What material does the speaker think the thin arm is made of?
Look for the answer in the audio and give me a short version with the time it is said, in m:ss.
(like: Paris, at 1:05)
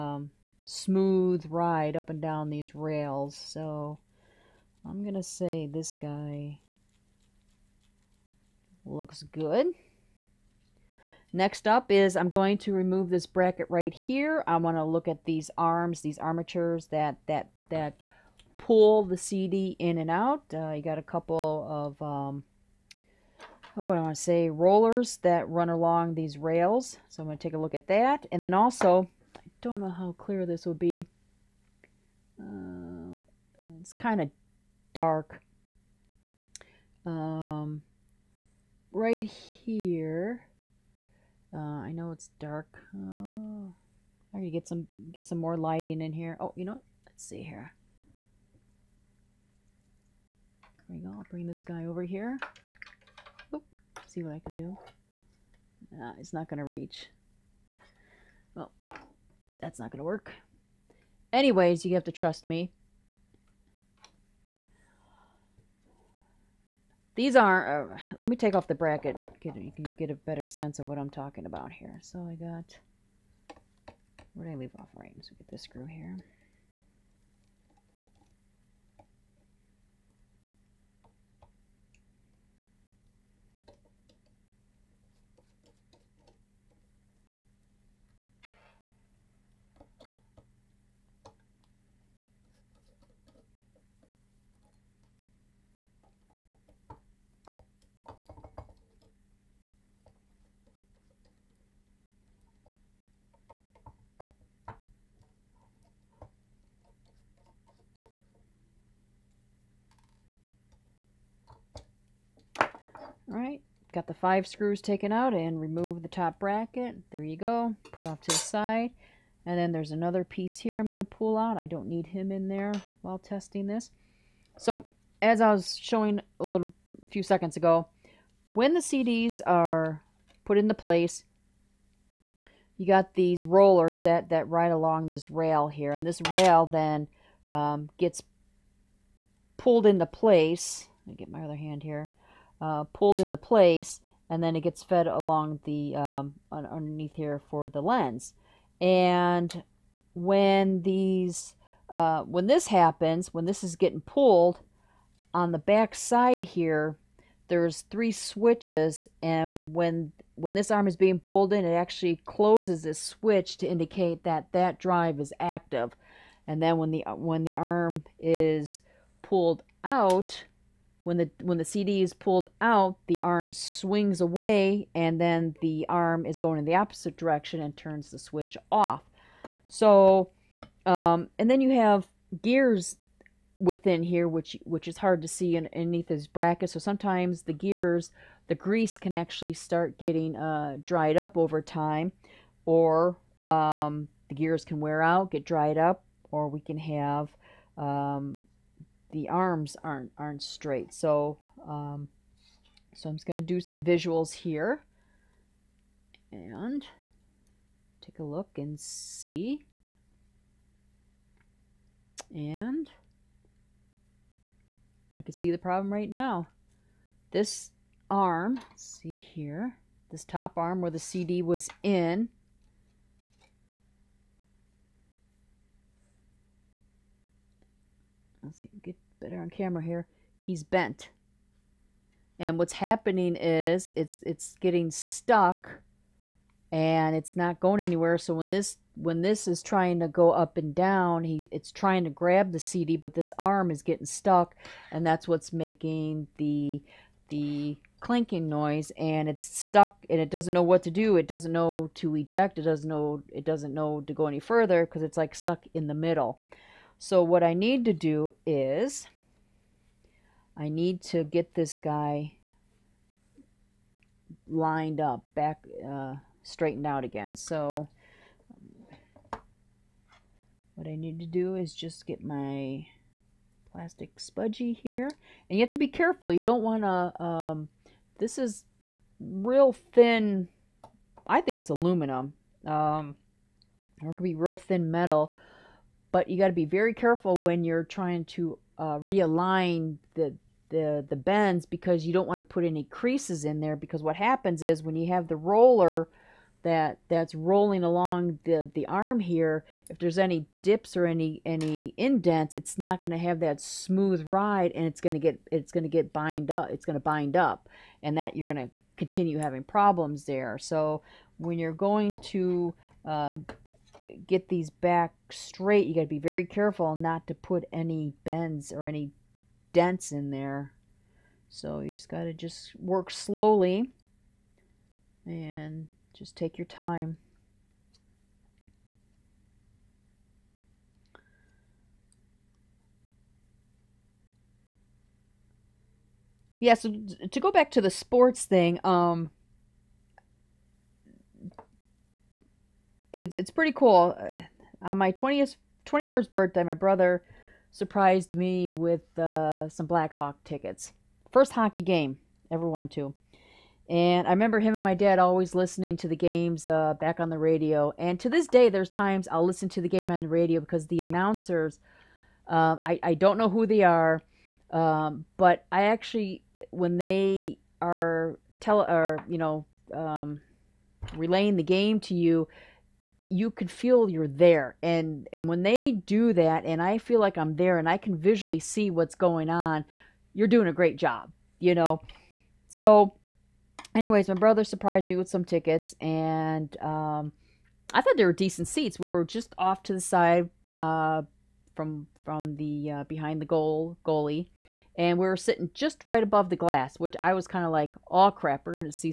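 aluminum, at 4:41.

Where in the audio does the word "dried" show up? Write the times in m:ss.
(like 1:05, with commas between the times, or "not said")
3:10, 3:15.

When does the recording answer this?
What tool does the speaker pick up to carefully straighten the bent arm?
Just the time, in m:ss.
4:33.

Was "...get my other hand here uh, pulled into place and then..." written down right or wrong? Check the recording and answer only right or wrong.
right.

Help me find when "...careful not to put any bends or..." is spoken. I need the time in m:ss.
5:16.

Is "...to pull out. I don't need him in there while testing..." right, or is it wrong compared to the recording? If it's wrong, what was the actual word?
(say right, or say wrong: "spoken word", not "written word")
right.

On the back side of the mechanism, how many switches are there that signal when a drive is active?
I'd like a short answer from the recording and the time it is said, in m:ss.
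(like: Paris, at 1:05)
3, at 2:37.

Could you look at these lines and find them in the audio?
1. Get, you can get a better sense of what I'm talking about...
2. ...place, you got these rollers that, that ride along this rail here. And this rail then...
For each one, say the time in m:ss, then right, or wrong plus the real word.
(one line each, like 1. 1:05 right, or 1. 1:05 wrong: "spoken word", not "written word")
1. 1:09 right
2. 2:10 right.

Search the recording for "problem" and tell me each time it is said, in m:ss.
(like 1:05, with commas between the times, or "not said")
3:35, 5:09.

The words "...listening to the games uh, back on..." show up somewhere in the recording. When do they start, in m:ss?
5:55.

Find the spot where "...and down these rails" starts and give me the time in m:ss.
0:02.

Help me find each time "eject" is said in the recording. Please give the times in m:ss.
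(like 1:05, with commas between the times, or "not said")
4:12.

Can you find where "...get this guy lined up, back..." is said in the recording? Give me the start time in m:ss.
4:21.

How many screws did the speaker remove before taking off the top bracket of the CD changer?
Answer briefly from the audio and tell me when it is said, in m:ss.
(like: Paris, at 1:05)
5, at 1:54.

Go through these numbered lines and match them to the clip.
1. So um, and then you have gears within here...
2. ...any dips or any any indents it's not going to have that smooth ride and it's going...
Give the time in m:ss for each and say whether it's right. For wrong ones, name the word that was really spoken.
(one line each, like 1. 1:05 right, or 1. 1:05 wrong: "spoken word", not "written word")
1. 2:59 right
2. 5:00 right.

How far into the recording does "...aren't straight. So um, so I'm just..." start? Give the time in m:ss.
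3:20.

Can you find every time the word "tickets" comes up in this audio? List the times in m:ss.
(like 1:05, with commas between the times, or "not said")
5:50, 6:25.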